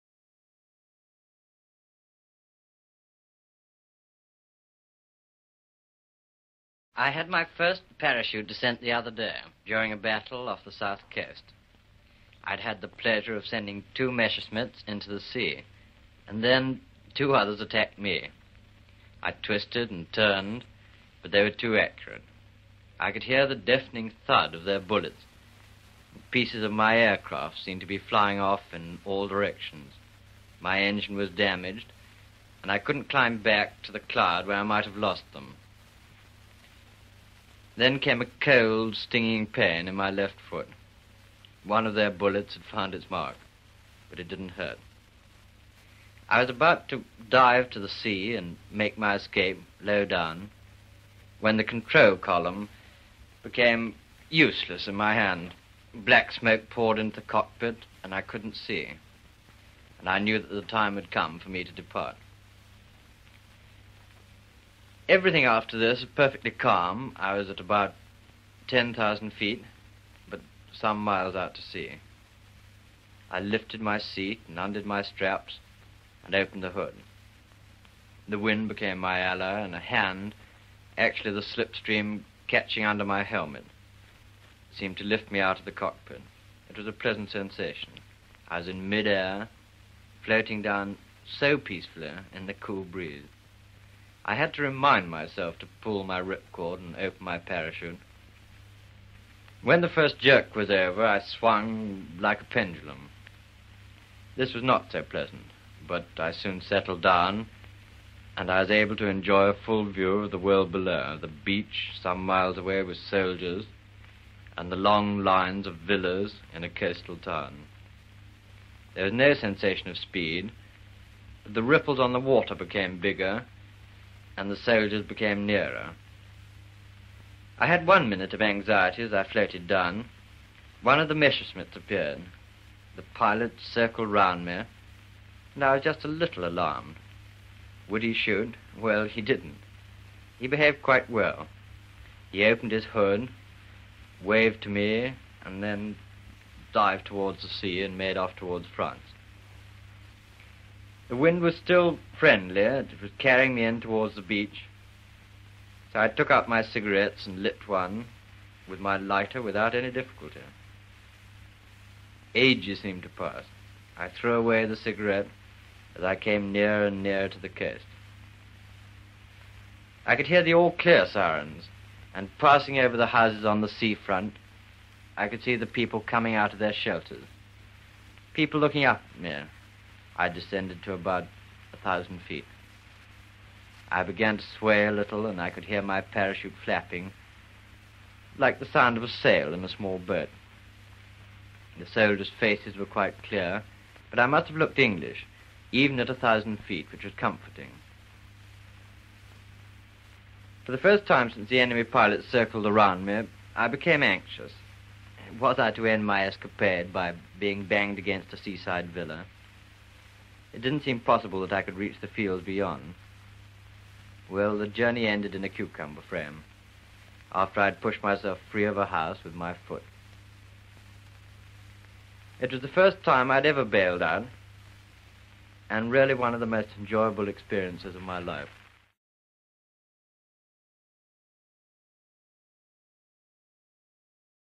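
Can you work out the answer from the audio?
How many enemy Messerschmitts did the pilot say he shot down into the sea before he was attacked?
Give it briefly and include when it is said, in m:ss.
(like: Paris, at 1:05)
2, at 0:13.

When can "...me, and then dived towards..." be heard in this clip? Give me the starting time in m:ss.
2:24.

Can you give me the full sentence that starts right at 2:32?
It was carrying me in towards the beach.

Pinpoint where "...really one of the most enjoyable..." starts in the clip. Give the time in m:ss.
3:45.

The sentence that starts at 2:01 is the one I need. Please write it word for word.
but The ripples on the water became bigger, and the soldiers became nearer.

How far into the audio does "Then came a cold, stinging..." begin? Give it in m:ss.
0:37.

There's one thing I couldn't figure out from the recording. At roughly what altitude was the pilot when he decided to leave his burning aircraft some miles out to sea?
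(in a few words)
10,000 feet.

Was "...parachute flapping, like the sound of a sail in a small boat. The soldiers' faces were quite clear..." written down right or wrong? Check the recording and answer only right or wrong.
right.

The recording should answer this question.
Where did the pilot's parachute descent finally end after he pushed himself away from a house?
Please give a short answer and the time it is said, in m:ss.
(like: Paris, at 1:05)
A cucumber frame, at 3:35.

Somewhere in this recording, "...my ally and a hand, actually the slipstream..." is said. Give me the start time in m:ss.
1:18.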